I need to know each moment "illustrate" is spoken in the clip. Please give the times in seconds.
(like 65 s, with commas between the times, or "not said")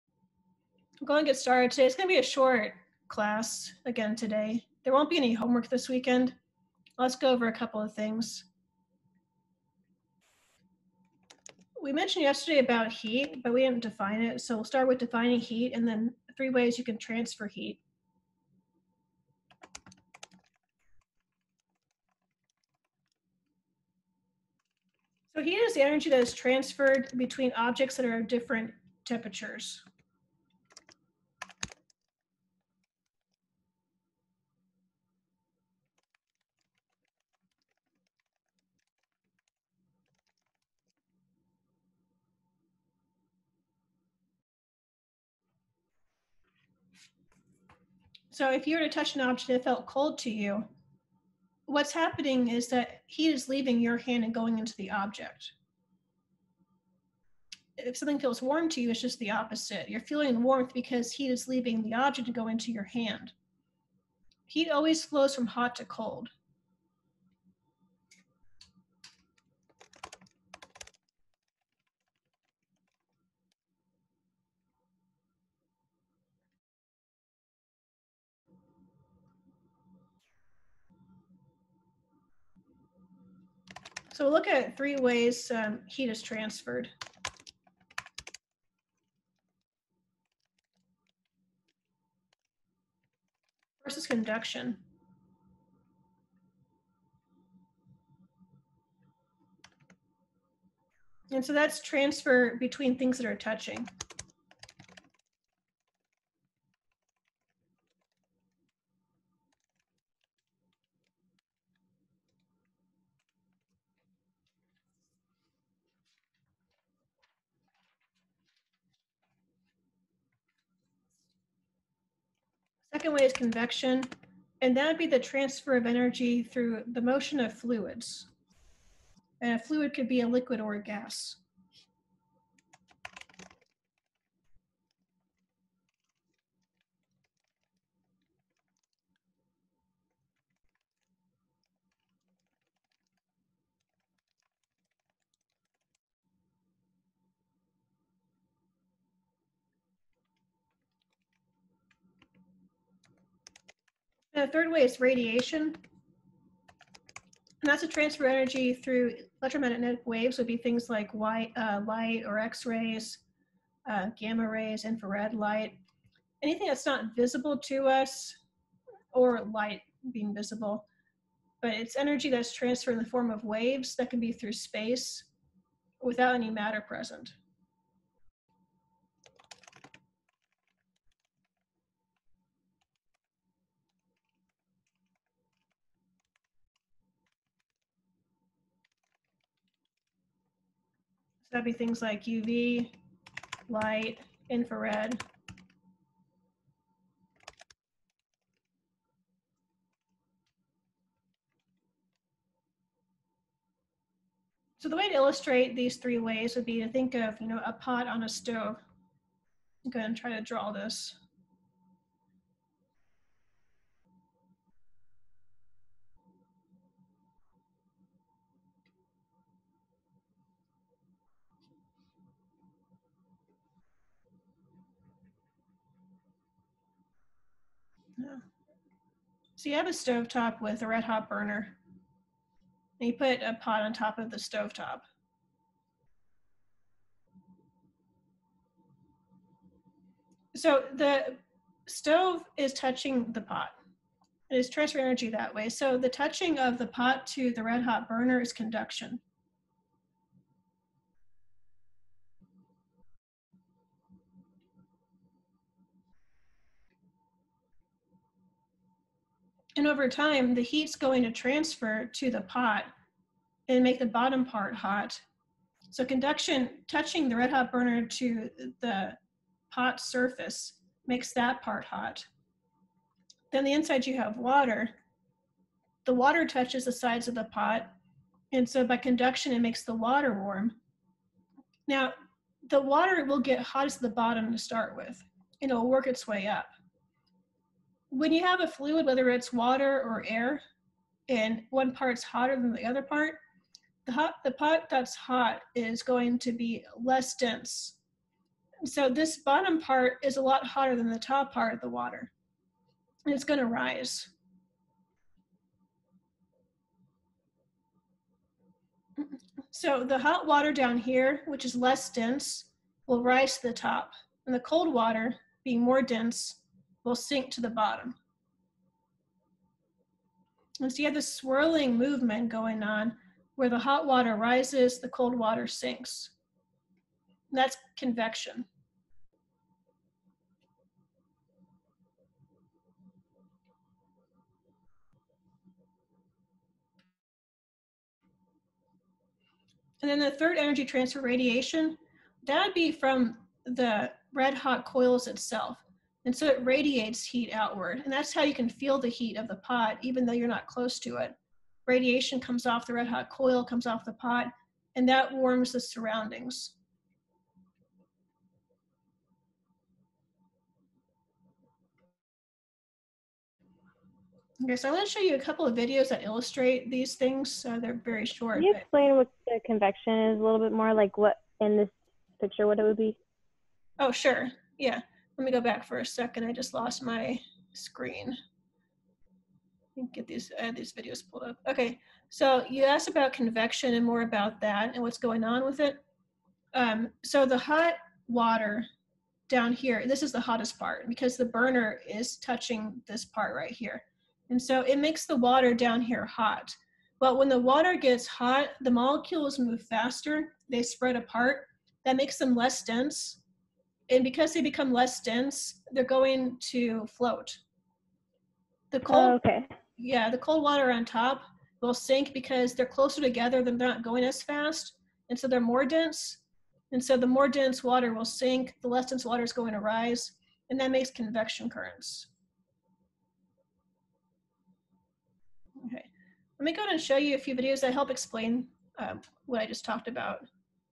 205 s, 366 s.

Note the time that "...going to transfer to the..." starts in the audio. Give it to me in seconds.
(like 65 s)
260 s.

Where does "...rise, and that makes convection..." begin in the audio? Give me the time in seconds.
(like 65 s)
419 s.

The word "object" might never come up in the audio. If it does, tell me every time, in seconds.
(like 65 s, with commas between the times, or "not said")
27 s, 49 s, 54 s, 61 s.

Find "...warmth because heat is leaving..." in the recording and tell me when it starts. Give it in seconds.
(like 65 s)
60 s.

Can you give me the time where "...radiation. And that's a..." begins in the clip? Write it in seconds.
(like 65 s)
155 s.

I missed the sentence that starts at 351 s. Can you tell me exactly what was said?
Radiation comes off the red hot coil, comes off the pot, and that warms the surroundings.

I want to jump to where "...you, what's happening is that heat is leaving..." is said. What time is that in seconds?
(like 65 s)
50 s.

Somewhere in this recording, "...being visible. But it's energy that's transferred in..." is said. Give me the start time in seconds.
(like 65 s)
170 s.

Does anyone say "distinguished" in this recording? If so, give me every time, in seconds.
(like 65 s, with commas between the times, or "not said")
not said.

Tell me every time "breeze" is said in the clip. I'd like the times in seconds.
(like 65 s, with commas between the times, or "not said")
not said.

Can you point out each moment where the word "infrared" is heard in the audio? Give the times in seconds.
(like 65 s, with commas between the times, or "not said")
164 s, 194 s.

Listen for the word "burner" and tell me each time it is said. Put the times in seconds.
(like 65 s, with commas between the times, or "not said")
231 s, 248 s, 267 s, 391 s.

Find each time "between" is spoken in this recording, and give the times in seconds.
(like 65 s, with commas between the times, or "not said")
27 s, 102 s.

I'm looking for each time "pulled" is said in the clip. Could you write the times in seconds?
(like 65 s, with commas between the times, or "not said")
381 s.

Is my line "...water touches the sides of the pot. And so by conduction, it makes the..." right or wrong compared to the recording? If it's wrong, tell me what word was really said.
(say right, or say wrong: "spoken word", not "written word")
right.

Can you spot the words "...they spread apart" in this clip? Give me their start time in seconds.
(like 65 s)
400 s.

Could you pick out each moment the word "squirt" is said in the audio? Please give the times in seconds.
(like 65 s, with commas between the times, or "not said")
not said.